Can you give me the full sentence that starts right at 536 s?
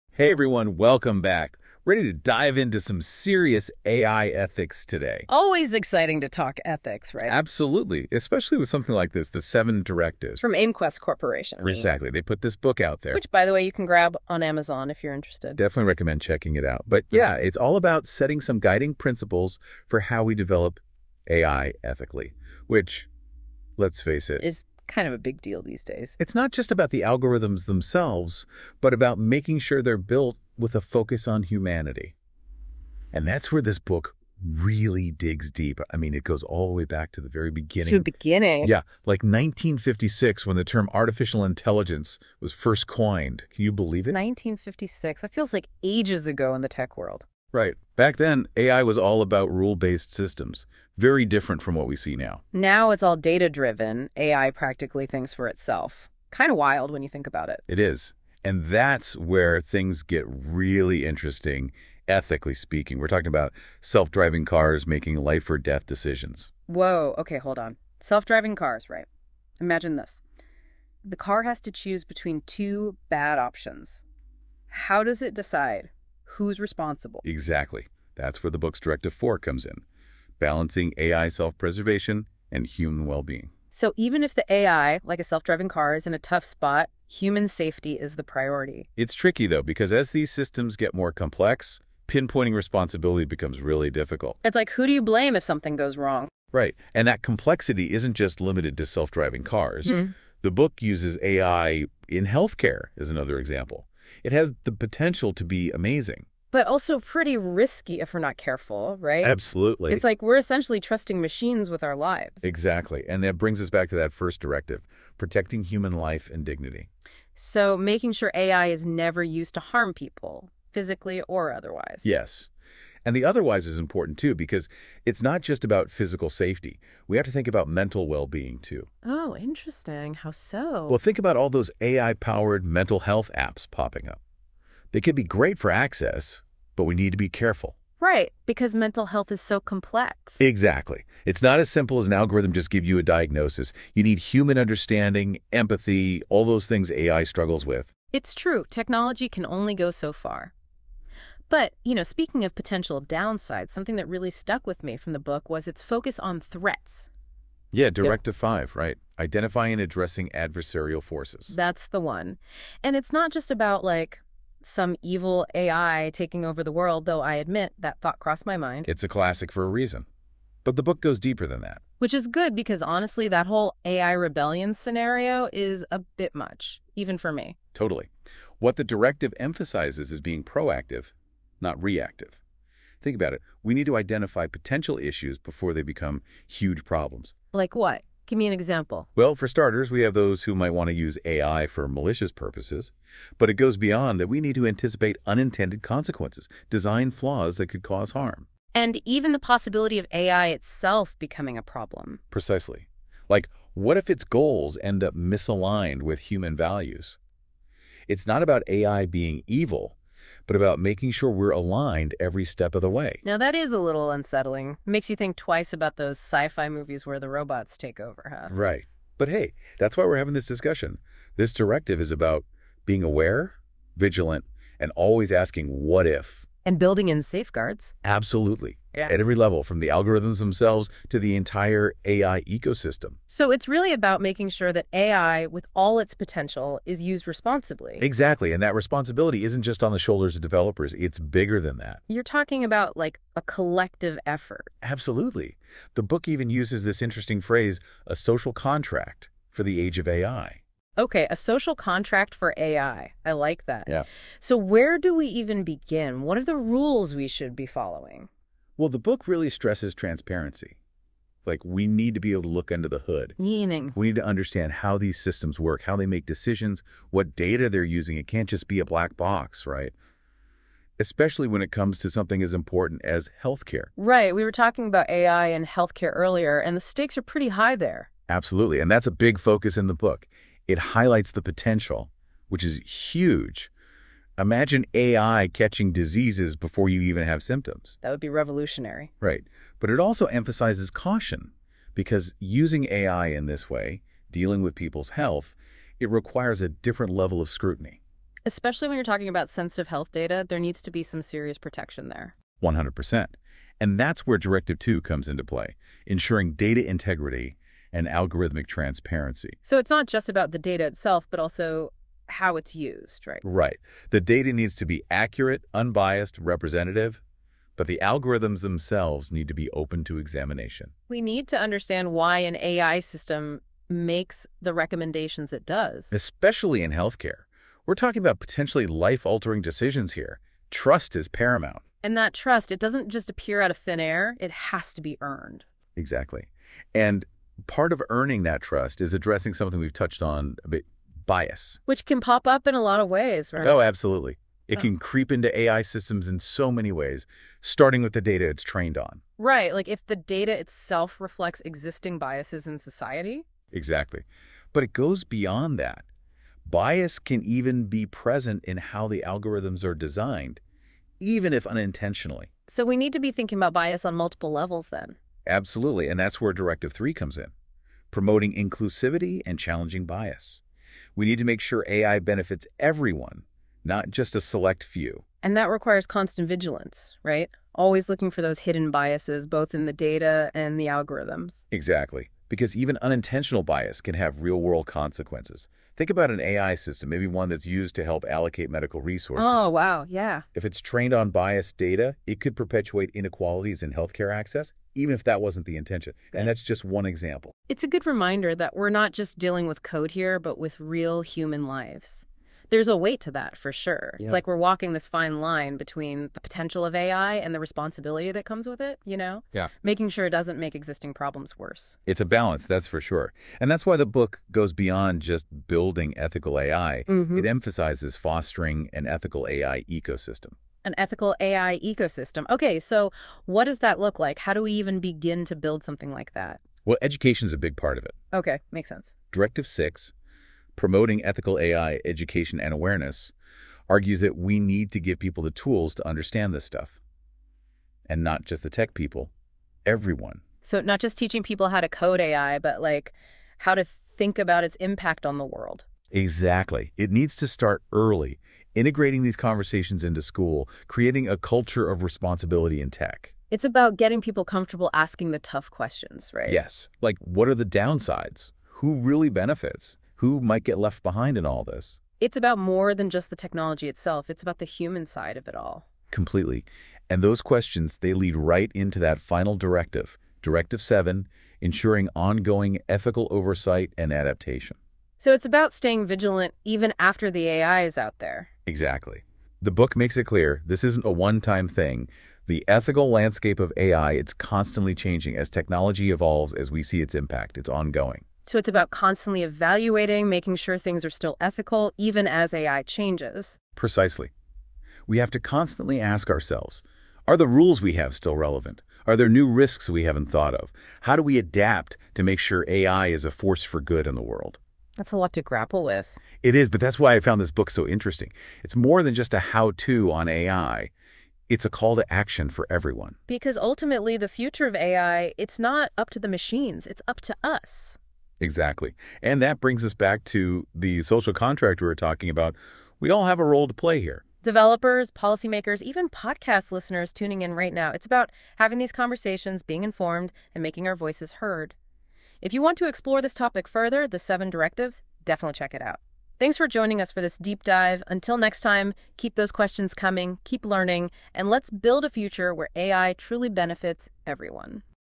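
Thanks for joining us for this deep dive.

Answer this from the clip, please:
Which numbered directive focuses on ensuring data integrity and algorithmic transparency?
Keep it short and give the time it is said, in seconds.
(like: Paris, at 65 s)
Directive 2, at 304 s.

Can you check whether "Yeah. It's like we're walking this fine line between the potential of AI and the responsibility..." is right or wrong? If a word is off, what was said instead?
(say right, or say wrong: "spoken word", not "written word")
right.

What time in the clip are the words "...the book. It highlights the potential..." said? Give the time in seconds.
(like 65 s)
279 s.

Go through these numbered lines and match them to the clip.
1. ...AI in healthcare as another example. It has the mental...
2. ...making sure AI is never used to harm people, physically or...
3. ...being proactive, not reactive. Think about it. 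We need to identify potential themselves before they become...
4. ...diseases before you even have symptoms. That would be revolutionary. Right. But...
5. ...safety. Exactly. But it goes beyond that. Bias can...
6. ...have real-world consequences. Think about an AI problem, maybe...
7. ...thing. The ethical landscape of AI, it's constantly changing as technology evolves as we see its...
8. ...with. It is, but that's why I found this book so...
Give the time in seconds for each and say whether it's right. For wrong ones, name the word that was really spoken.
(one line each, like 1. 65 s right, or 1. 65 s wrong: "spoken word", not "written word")
1. 101 s wrong: "potential", not "mental"
2. 117 s right
3. 180 s wrong: "issues", not "themselves"
4. 285 s right
5. 352 s wrong: "society", not "safety"
6. 384 s wrong: "system", not "problem"
7. 481 s right
8. 505 s right.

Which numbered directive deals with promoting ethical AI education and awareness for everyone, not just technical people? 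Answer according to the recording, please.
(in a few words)
Directive 6.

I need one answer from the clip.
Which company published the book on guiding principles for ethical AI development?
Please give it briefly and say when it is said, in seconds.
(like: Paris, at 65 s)
AIMQWEST Corporation, at 10 s.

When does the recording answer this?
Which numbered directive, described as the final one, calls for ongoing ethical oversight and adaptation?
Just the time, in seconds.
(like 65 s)
470 s.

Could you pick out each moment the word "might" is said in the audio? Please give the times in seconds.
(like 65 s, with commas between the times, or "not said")
190 s, 460 s.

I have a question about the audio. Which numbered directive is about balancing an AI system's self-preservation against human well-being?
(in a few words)
Directive 4.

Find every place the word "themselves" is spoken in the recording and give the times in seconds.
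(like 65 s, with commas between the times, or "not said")
27 s, 230 s, 318 s.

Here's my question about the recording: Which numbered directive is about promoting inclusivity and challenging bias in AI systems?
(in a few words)
Directive 3.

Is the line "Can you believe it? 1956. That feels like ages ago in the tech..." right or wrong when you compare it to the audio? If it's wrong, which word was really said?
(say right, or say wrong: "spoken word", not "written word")
right.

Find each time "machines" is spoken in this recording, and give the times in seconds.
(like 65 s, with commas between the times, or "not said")
111 s, 516 s.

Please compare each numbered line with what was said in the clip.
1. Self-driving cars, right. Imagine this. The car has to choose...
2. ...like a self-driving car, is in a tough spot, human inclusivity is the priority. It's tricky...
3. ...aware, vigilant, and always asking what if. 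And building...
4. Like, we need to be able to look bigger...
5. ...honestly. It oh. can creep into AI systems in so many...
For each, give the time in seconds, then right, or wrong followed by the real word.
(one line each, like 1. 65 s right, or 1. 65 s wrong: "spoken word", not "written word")
1. 67 s right
2. 85 s wrong: "safety", not "inclusivity"
3. 223 s right
4. 261 s wrong: "under", not "bigger"
5. 343 s wrong: "absolutely", not "honestly".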